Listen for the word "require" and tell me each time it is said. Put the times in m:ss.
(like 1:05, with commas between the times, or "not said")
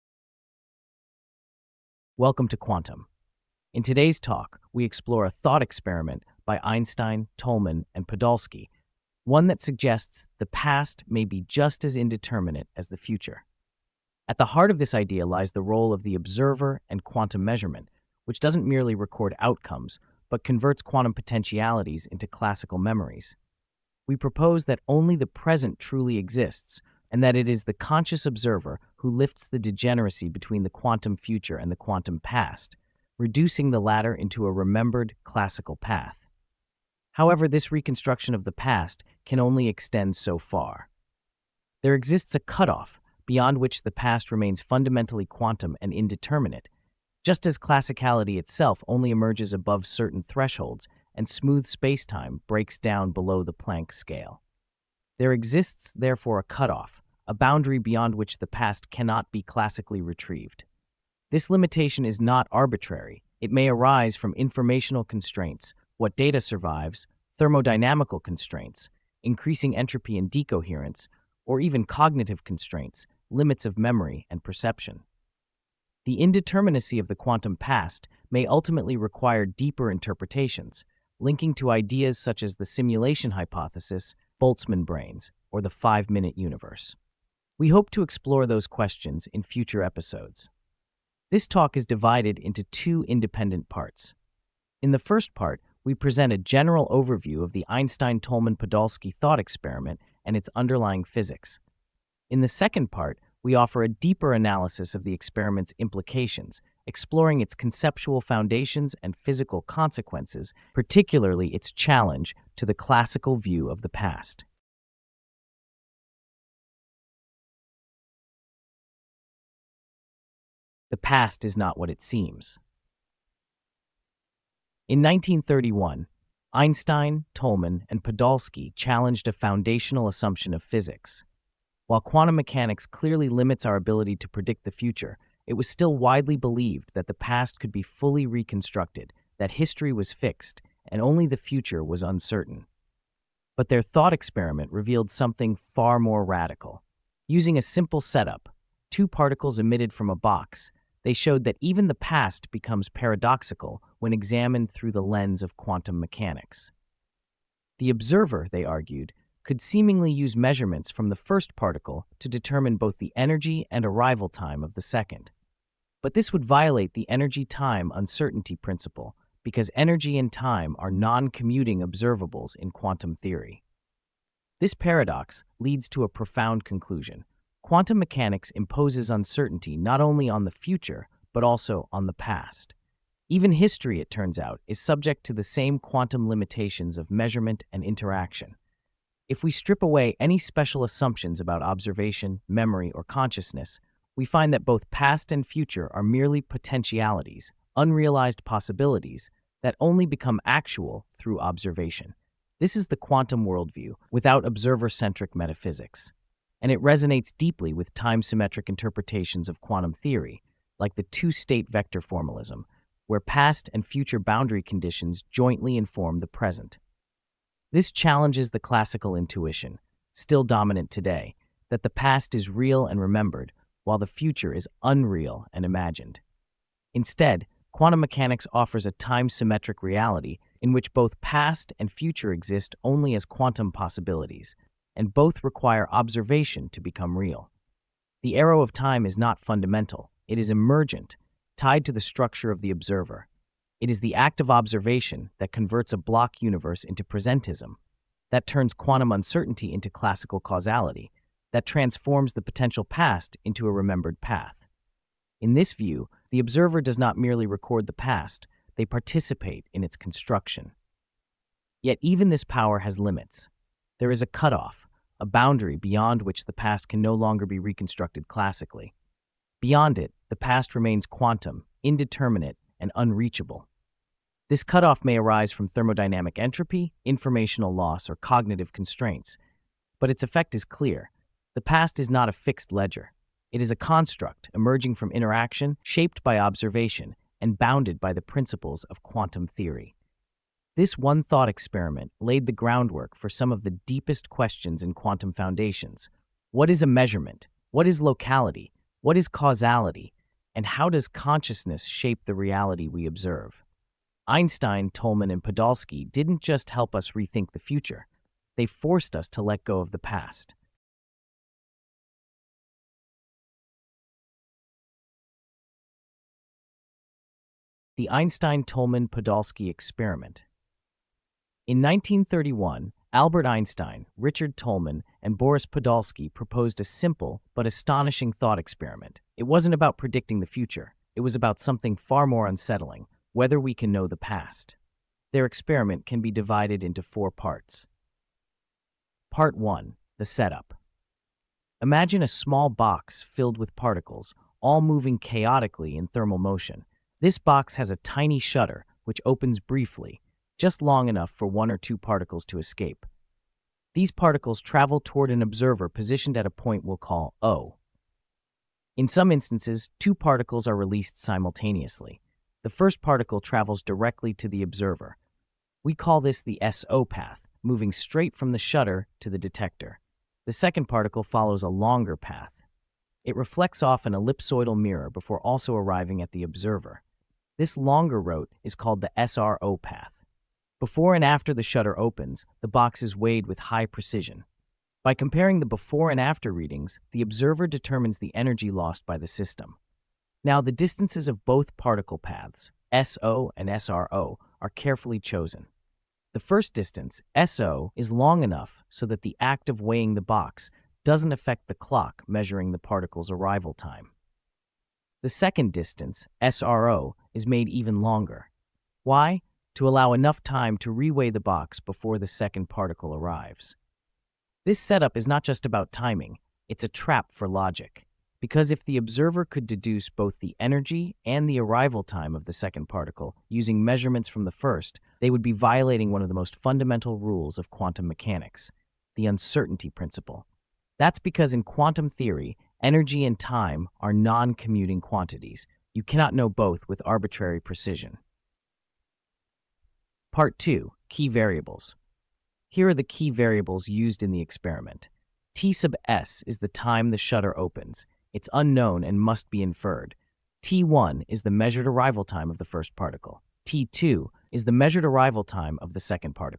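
1:18, 3:55.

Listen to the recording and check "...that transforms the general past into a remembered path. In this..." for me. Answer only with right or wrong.
wrong.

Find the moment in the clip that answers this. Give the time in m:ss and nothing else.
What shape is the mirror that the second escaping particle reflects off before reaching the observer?
6:14.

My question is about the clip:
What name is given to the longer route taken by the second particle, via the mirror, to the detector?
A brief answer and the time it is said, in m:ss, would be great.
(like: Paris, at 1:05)
SRO path, at 6:19.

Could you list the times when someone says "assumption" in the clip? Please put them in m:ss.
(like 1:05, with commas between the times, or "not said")
2:10, 3:10.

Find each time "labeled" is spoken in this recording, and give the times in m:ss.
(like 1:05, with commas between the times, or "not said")
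not said.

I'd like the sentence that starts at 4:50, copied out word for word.
This one thought experiment laid the groundwork for some of the deepest questions in quantum foundations.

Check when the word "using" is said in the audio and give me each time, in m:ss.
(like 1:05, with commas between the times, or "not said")
2:27, 7:03.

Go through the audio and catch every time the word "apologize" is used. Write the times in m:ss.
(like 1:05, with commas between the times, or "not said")
not said.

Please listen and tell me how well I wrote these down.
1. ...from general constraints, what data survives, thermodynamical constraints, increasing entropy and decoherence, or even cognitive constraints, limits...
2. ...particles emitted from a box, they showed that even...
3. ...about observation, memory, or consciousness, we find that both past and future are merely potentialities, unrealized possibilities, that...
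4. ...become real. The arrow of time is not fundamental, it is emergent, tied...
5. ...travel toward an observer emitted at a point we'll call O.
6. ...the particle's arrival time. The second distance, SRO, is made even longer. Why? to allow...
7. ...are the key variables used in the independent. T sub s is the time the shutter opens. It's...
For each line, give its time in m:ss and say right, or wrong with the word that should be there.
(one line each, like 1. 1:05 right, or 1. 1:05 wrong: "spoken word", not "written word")
1. 1:04 wrong: "informational", not "general"
2. 2:29 right
3. 3:11 right
4. 3:56 right
5. 5:54 wrong: "positioned", not "emitted"
6. 6:42 right
7. 7:22 wrong: "experiment", not "independent".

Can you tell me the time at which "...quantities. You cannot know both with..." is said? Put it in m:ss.
7:14.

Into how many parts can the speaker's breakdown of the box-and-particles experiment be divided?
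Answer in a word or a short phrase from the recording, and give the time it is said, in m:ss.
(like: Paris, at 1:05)
4, at 5:37.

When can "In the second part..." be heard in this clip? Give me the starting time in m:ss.
1:42.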